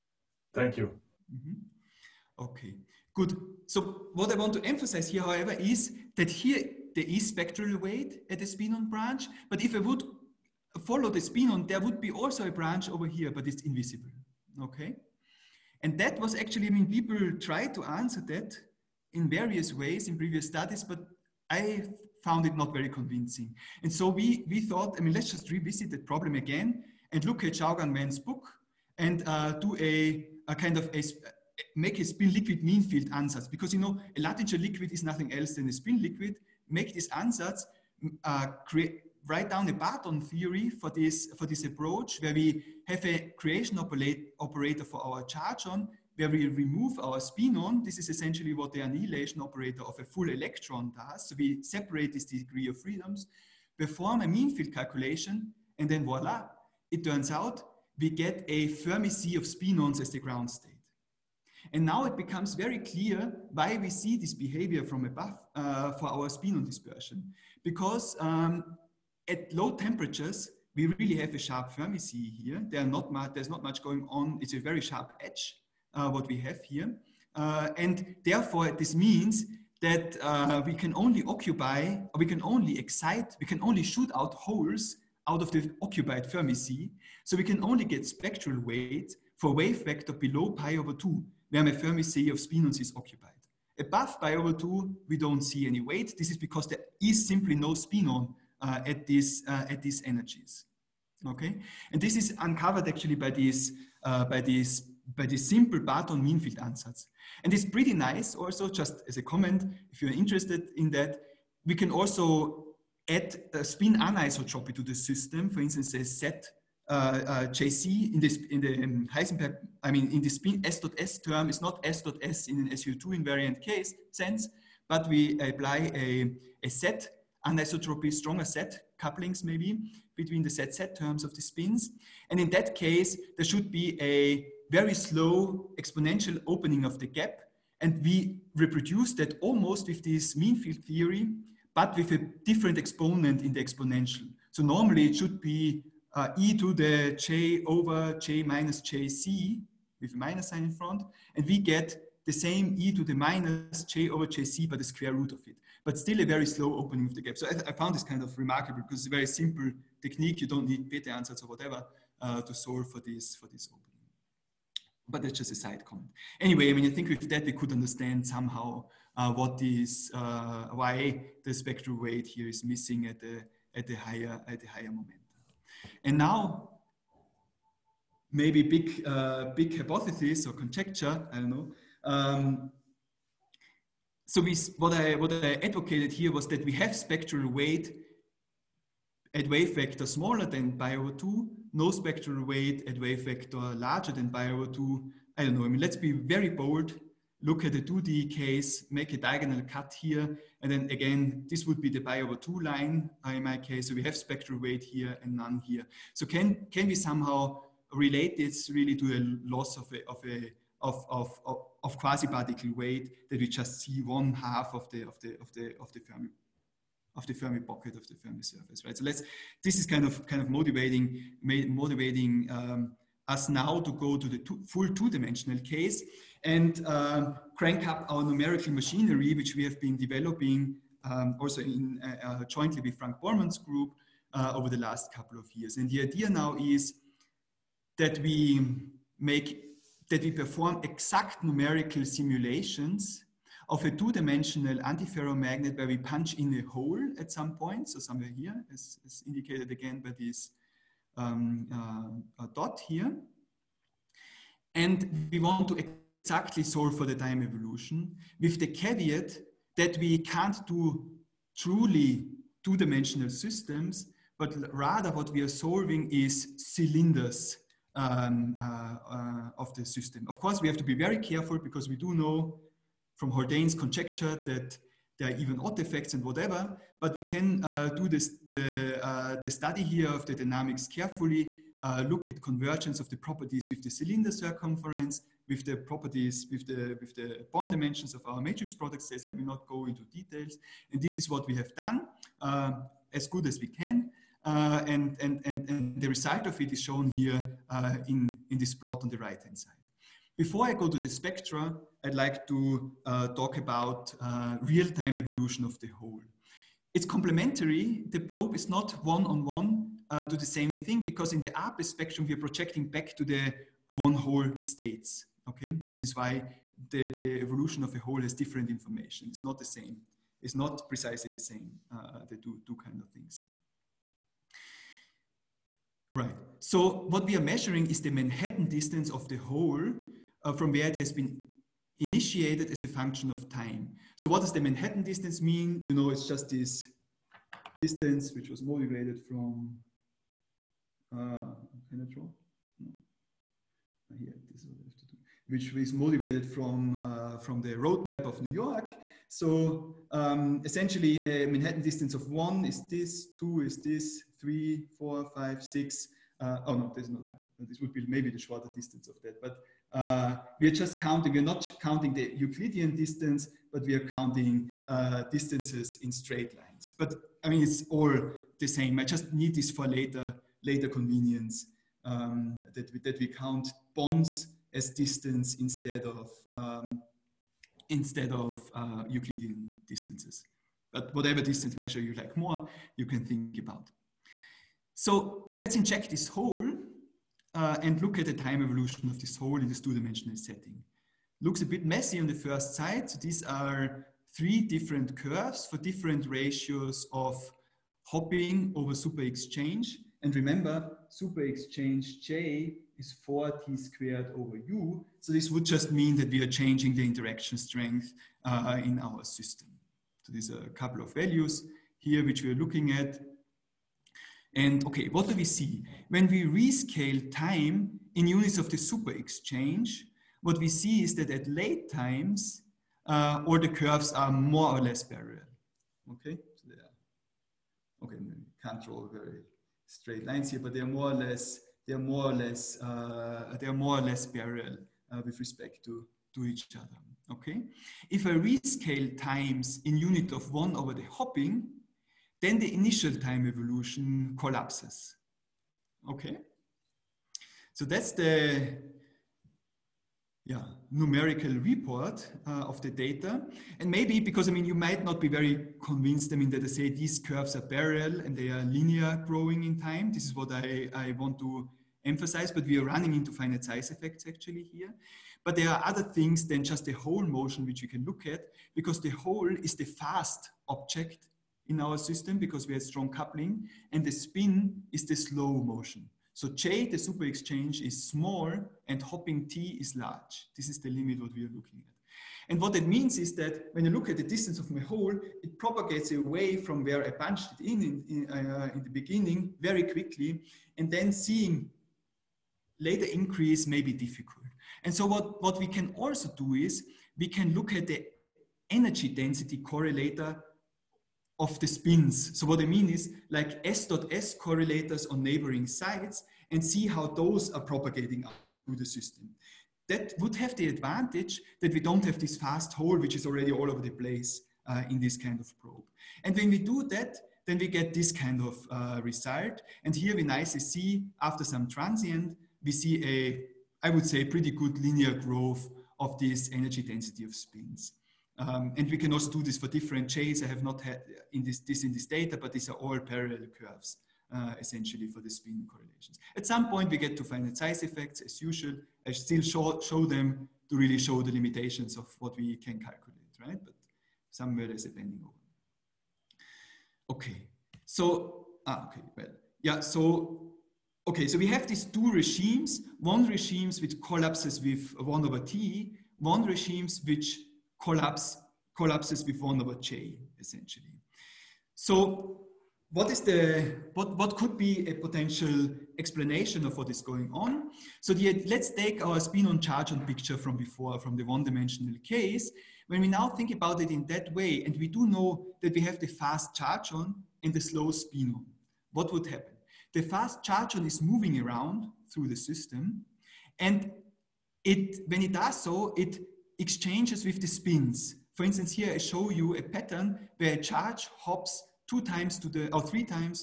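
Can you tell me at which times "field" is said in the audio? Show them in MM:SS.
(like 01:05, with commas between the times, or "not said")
00:32, 00:54, 01:46, 02:20.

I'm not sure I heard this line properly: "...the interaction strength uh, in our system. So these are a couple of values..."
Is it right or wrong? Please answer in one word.
right.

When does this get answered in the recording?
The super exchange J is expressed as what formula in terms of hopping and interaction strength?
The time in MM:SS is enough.
06:43.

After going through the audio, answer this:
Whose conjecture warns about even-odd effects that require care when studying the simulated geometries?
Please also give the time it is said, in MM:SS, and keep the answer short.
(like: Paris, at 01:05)
Haldane, at 04:33.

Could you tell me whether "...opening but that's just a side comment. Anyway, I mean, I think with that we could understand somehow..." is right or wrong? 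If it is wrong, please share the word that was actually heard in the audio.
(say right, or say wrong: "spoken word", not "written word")
right.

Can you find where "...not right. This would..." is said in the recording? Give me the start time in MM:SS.
05:57.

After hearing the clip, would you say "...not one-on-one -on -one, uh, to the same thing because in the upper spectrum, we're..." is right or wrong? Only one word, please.
right.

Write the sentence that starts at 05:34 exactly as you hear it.
So what does the Manhattan distance mean?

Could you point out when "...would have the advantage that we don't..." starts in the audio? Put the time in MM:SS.
08:30.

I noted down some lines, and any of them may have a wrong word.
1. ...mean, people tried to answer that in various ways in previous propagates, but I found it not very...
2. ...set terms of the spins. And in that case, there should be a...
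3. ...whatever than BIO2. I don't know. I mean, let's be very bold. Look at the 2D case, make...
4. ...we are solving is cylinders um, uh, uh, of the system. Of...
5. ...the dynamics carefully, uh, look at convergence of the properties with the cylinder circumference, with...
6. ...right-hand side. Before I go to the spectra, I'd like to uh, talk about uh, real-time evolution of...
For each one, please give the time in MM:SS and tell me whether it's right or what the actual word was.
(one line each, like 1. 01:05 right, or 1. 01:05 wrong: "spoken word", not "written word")
1. 00:16 wrong: "studies", not "propagates"
2. 02:10 right
3. 03:13 wrong: "larger", not "whatever"
4. 04:25 right
5. 04:40 right
6. 04:59 right.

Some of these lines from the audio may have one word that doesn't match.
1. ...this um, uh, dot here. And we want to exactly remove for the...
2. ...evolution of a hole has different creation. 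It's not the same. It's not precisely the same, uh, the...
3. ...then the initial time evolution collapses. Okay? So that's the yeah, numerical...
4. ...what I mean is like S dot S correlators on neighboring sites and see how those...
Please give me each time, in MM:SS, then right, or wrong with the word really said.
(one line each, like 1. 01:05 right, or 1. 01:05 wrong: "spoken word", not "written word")
1. 04:10 wrong: "solve", not "remove"
2. 05:17 wrong: "information", not "creation"
3. 07:22 right
4. 08:22 right.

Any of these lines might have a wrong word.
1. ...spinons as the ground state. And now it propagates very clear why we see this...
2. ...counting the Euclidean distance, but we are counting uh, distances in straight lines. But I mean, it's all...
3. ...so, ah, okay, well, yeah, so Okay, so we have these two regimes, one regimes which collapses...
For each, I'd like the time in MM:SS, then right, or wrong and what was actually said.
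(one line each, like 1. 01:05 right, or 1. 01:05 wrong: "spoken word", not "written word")
1. 00:59 wrong: "becomes", not "propagates"
2. 06:01 right
3. 09:07 right.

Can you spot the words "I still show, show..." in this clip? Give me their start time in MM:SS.
08:59.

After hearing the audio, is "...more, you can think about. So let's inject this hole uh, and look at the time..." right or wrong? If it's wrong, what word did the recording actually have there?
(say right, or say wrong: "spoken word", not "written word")
right.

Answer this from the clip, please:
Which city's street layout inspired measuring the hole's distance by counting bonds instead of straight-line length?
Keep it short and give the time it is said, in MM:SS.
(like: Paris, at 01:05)
New York, at 05:48.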